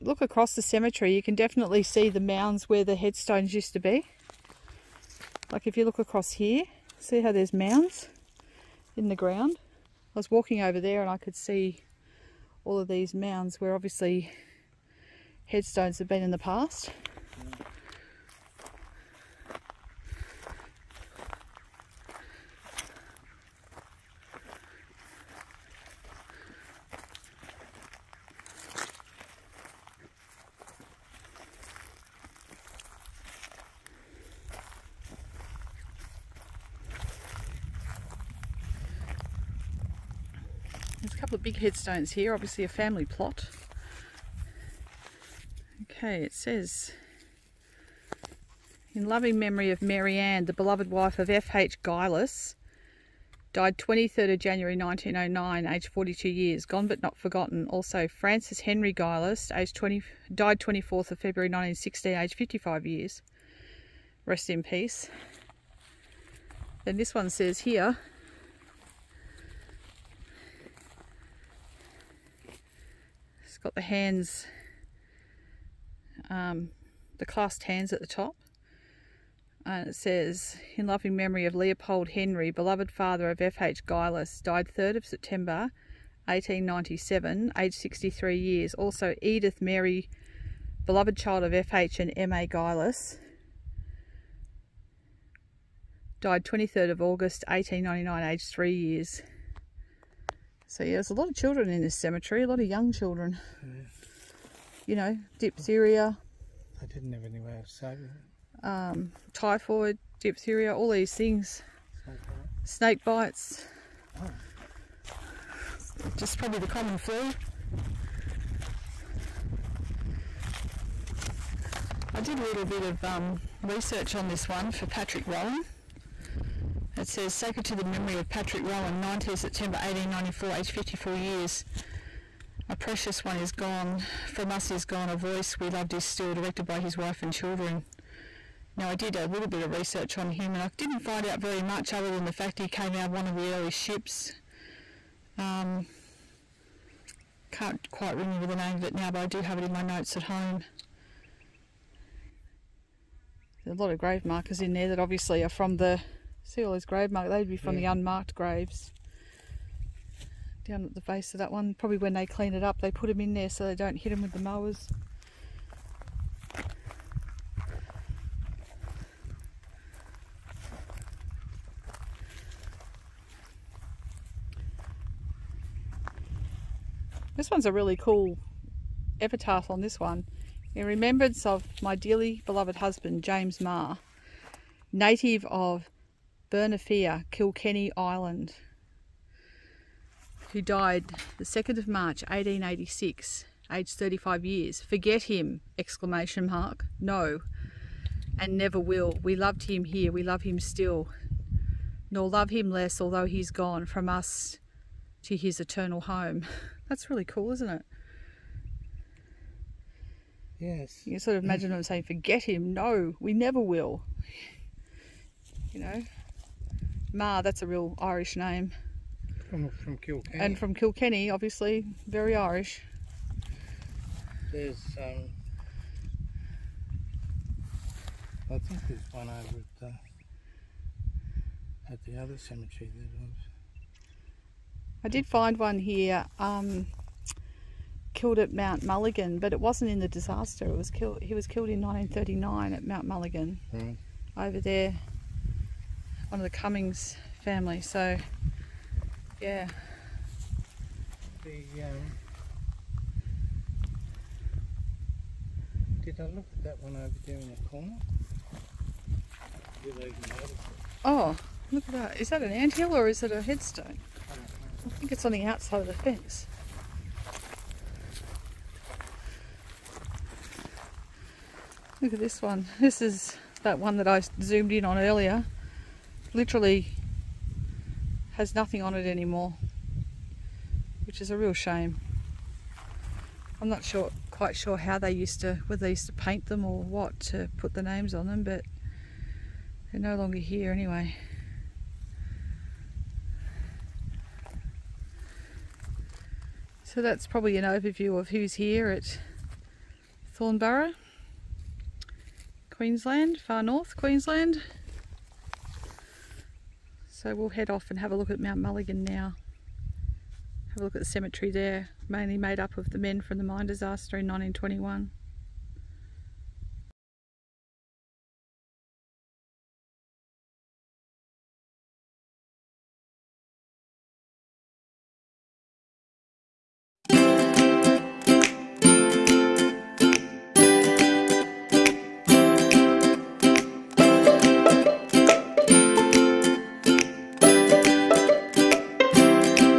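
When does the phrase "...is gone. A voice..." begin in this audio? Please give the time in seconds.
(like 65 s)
134 s.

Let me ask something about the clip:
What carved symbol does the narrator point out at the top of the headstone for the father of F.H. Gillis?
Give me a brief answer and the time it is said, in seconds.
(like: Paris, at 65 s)
clasped hands, at 77 s.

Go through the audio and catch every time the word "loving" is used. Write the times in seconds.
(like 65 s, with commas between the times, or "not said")
49 s, 80 s.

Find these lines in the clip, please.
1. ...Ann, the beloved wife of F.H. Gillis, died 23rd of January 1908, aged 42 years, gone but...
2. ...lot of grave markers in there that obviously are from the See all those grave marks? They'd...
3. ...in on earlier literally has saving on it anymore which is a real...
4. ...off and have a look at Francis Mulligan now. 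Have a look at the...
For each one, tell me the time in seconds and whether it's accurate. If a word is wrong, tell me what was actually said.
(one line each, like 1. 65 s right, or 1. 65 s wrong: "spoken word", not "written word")
1. 50 s wrong: "1909", not "1908"
2. 153 s right
3. 274 s wrong: "nothing", not "saving"
4. 307 s wrong: "Mount", not "Francis".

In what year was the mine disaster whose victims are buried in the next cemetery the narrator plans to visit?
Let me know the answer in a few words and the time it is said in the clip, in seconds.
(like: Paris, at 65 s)
1921, at 314 s.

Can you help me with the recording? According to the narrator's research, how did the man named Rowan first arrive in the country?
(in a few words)
one of the early ships.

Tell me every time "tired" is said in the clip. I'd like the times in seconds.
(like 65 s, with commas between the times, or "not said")
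not said.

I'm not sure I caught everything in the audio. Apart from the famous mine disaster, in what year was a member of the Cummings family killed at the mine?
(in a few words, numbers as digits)
1939.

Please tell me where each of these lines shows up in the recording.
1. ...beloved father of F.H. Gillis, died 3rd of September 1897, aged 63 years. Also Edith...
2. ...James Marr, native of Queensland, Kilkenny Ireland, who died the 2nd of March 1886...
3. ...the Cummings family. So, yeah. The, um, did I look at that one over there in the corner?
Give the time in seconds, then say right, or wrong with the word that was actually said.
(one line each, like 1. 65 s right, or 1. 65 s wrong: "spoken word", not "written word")
1. 82 s right
2. 183 s wrong: "Bernafia", not "Queensland"
3. 246 s right.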